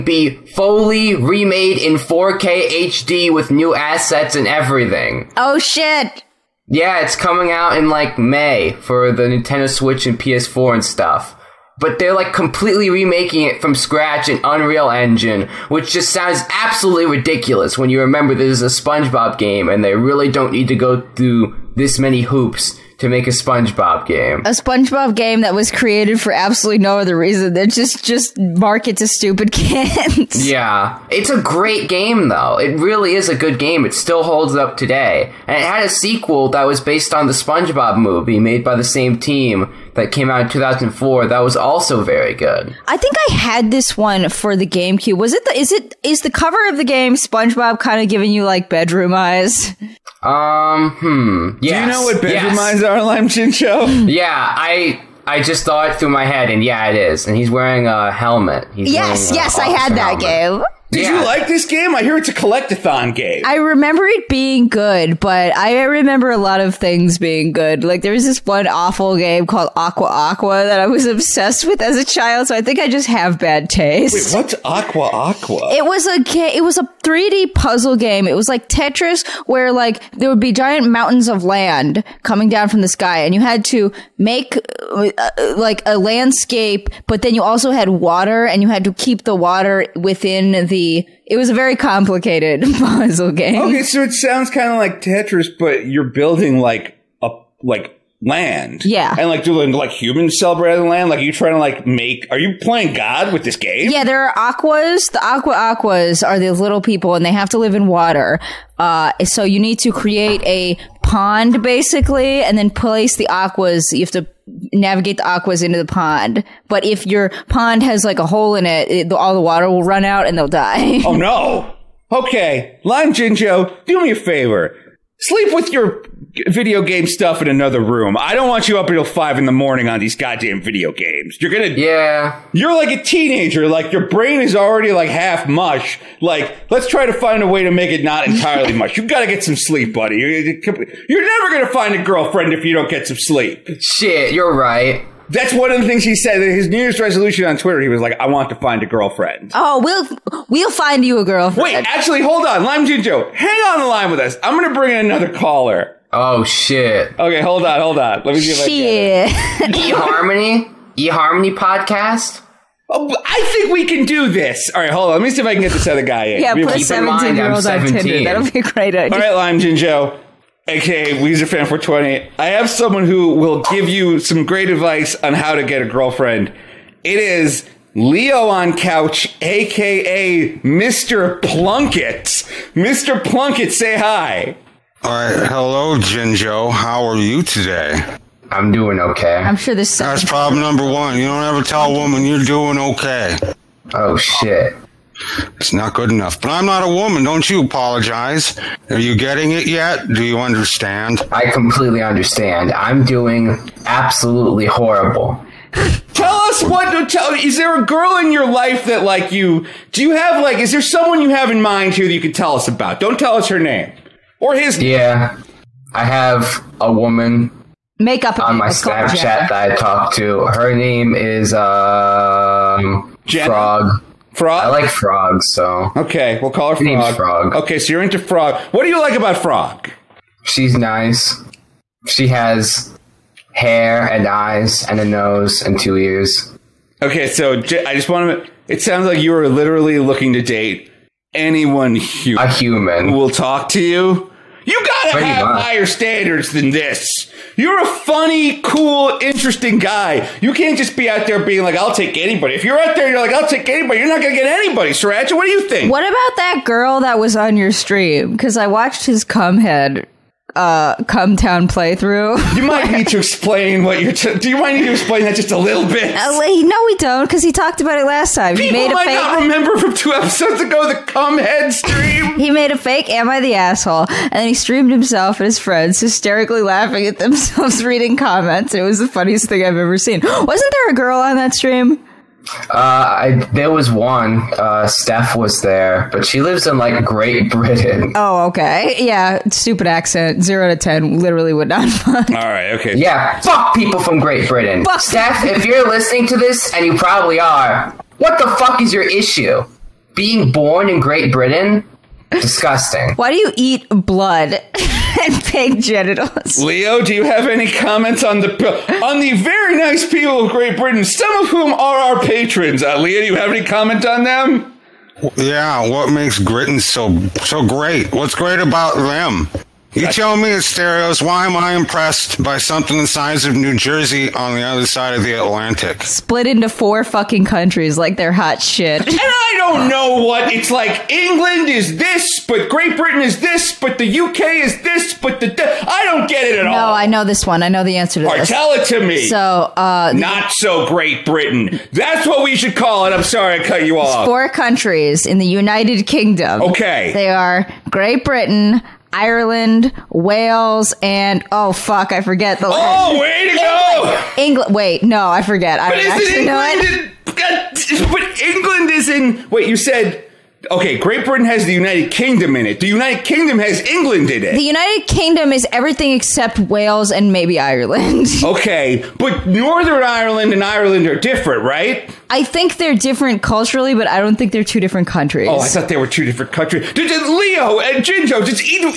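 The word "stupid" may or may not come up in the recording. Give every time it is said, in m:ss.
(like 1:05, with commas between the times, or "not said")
0:29, 4:49.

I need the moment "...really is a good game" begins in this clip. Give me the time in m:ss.
0:32.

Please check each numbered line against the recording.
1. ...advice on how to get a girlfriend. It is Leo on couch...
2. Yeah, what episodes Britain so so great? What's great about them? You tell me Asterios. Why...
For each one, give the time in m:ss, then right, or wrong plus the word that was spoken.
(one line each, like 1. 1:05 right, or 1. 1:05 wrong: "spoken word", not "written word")
1. 2:54 right
2. 5:15 wrong: "makes", not "episodes".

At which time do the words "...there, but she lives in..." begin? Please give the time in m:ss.
4:45.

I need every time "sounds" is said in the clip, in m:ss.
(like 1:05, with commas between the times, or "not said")
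0:16, 1:34, 3:58.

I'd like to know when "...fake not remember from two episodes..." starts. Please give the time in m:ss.
4:29.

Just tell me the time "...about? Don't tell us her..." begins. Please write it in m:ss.
3:32.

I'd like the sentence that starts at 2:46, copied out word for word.
yeah, put 17 year old on Tinder.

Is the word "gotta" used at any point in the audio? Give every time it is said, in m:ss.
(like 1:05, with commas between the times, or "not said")
2:19, 4:04.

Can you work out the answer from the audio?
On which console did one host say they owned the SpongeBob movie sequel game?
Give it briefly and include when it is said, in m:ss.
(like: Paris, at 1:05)
GameCube, at 0:44.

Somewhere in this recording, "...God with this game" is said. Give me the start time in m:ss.
1:42.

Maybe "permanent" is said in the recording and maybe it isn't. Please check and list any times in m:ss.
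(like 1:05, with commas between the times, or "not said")
not said.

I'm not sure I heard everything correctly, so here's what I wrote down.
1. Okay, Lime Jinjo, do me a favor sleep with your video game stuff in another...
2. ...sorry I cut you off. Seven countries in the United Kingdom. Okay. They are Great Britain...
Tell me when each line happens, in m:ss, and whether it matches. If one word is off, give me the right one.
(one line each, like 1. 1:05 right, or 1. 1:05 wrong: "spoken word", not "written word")
1. 2:02 right
2. 5:43 wrong: "Four", not "Seven".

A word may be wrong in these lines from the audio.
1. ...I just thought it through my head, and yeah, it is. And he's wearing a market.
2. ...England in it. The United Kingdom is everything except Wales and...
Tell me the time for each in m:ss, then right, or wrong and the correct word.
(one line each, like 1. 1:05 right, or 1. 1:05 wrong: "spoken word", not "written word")
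1. 0:55 wrong: "helmet", not "market"
2. 6:03 right.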